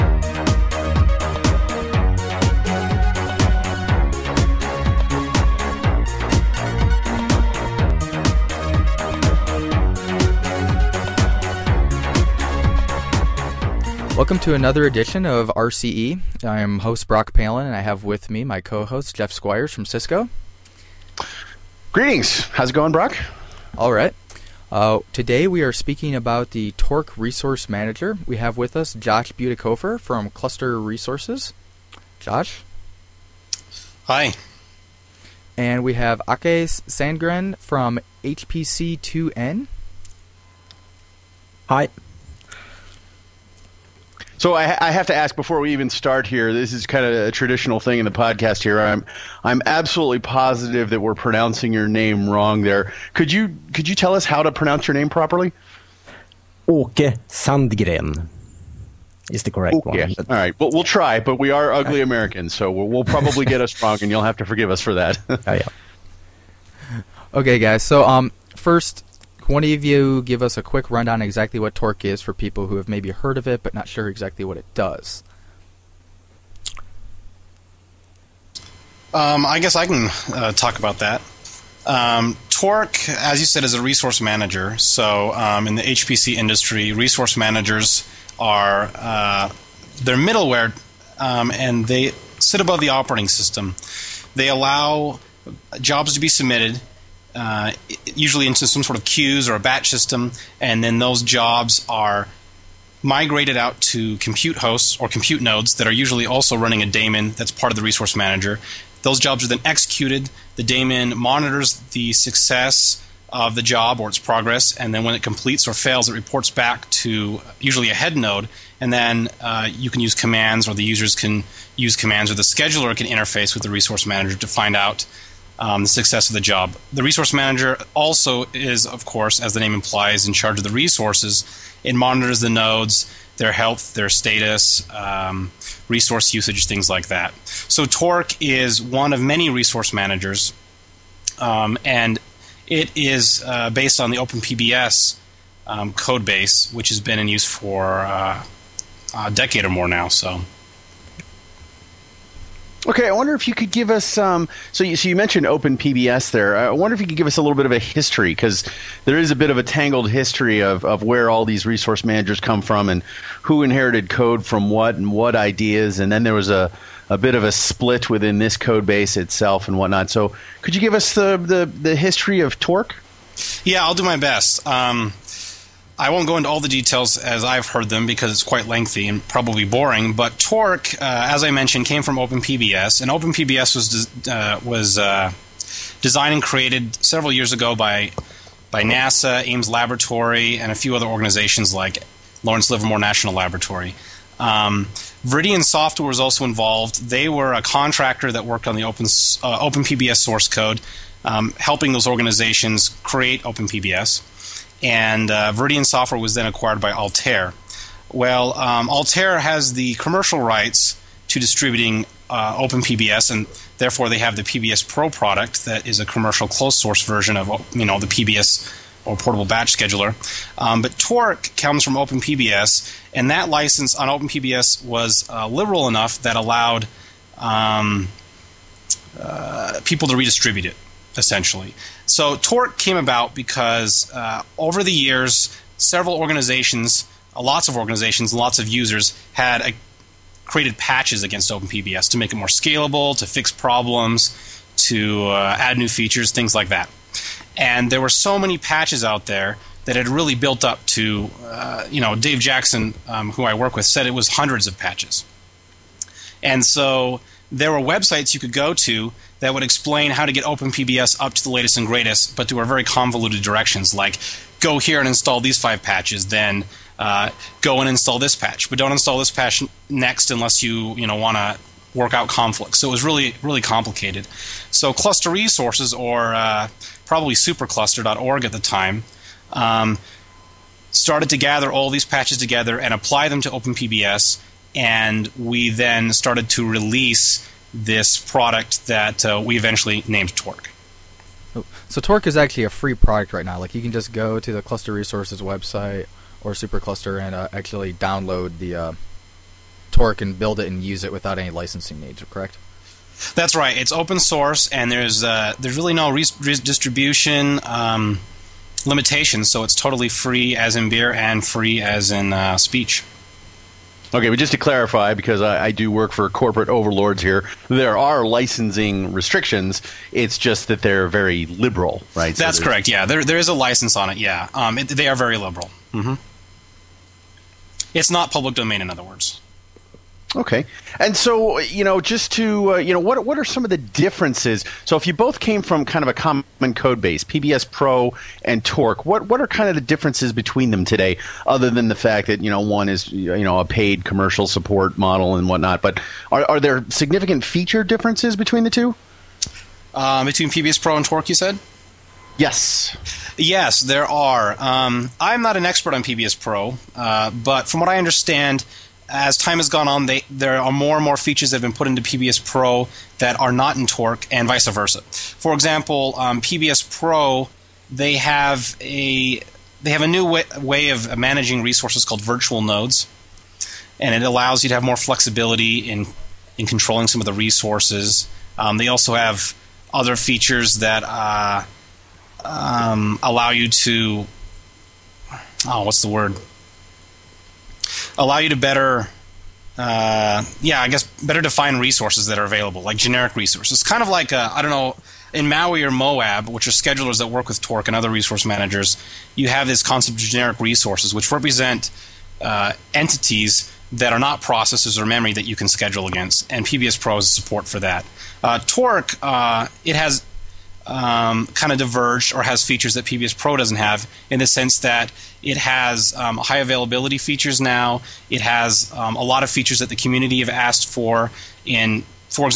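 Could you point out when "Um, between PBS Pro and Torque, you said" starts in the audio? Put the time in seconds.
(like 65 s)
349 s.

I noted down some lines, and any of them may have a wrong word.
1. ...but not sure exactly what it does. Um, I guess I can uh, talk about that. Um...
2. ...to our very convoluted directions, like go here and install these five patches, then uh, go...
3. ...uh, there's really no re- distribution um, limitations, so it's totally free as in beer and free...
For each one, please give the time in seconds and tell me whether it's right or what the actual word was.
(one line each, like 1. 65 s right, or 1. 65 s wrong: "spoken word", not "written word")
1. 73 s right
2. 262 s right
3. 305 s right.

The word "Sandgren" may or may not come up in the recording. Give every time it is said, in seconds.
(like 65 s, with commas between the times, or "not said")
36 s, 57 s.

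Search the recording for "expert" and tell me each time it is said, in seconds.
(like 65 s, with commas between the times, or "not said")
355 s.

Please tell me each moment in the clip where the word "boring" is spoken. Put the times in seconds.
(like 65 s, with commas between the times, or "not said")
179 s.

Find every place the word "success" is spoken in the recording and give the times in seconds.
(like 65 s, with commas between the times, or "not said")
112 s, 125 s.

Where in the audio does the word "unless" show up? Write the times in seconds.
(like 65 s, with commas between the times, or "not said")
270 s.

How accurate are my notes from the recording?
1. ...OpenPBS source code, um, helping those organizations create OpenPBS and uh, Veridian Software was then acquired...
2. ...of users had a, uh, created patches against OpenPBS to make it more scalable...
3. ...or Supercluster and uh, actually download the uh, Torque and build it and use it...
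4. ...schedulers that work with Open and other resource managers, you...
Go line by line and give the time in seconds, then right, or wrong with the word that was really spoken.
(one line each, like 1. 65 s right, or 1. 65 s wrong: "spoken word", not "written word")
1. 199 s right
2. 238 s right
3. 296 s right
4. 396 s wrong: "Torque", not "Open".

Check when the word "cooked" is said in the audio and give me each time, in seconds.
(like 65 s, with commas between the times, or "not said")
not said.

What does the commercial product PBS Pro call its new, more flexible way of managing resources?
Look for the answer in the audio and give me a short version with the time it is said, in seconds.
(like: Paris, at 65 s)
virtual nodes, at 372 s.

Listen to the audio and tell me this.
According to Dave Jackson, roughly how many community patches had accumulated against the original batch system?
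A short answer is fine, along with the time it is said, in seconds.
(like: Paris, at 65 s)
hundreds, at 254 s.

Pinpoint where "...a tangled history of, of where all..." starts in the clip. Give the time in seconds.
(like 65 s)
159 s.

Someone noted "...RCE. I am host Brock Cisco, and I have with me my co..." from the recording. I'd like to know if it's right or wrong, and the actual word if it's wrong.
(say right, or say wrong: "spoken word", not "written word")
wrong: "Palen", not "Cisco".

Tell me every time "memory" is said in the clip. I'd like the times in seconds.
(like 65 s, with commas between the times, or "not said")
405 s.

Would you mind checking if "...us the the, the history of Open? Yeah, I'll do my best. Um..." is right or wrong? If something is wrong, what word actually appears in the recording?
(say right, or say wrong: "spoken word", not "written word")
wrong: "Torque", not "Open".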